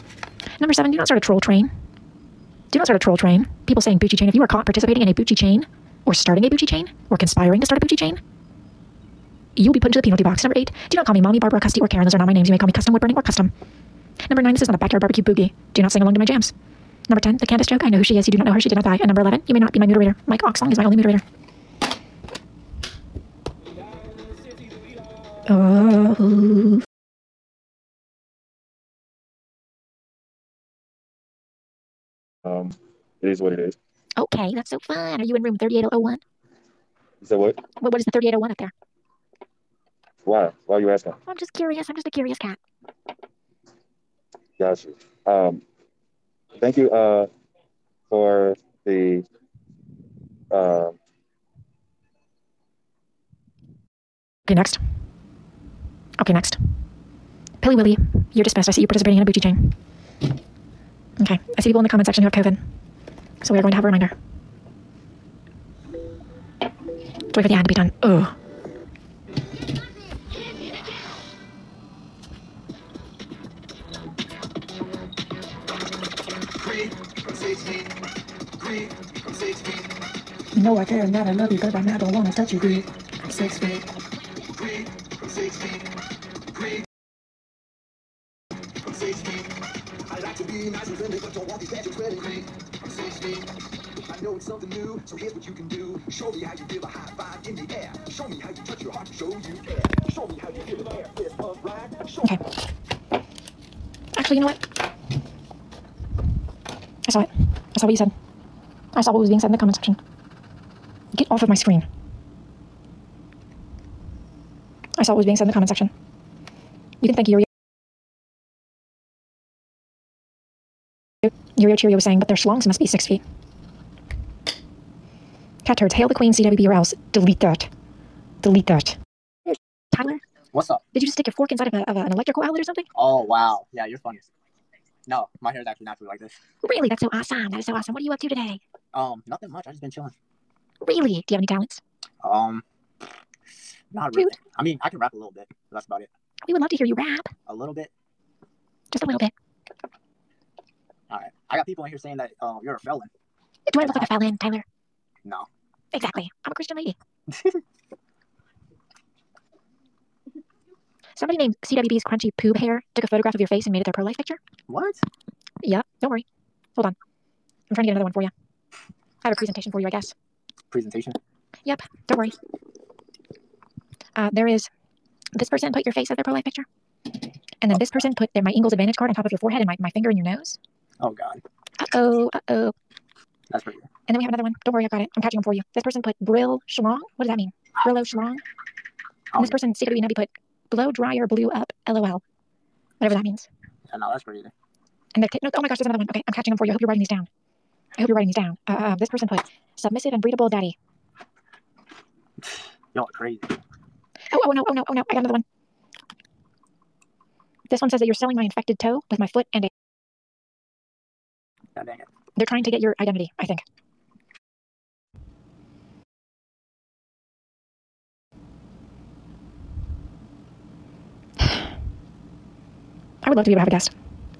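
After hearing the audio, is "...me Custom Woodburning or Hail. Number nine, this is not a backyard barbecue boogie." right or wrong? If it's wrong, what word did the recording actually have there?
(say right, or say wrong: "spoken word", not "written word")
wrong: "Custom", not "Hail".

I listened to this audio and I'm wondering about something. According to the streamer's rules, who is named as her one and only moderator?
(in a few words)
Mike Oxlong.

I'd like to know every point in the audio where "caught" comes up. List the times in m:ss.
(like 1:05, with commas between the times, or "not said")
0:04.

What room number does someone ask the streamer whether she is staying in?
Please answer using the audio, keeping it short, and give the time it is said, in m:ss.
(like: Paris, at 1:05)
3801, at 0:35.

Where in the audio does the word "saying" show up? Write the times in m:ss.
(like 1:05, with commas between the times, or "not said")
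0:03, 2:02, 2:31.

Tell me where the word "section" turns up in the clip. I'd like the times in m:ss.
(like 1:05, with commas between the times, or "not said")
1:02, 1:49, 1:55.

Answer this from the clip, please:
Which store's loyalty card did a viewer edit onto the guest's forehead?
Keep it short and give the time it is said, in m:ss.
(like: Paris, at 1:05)
Ingles Advantage card, at 2:58.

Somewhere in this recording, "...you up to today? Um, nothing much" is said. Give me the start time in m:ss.
2:18.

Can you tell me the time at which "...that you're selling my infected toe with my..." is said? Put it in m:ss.
3:27.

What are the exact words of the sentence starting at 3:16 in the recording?
Okay, I'm catching them for you.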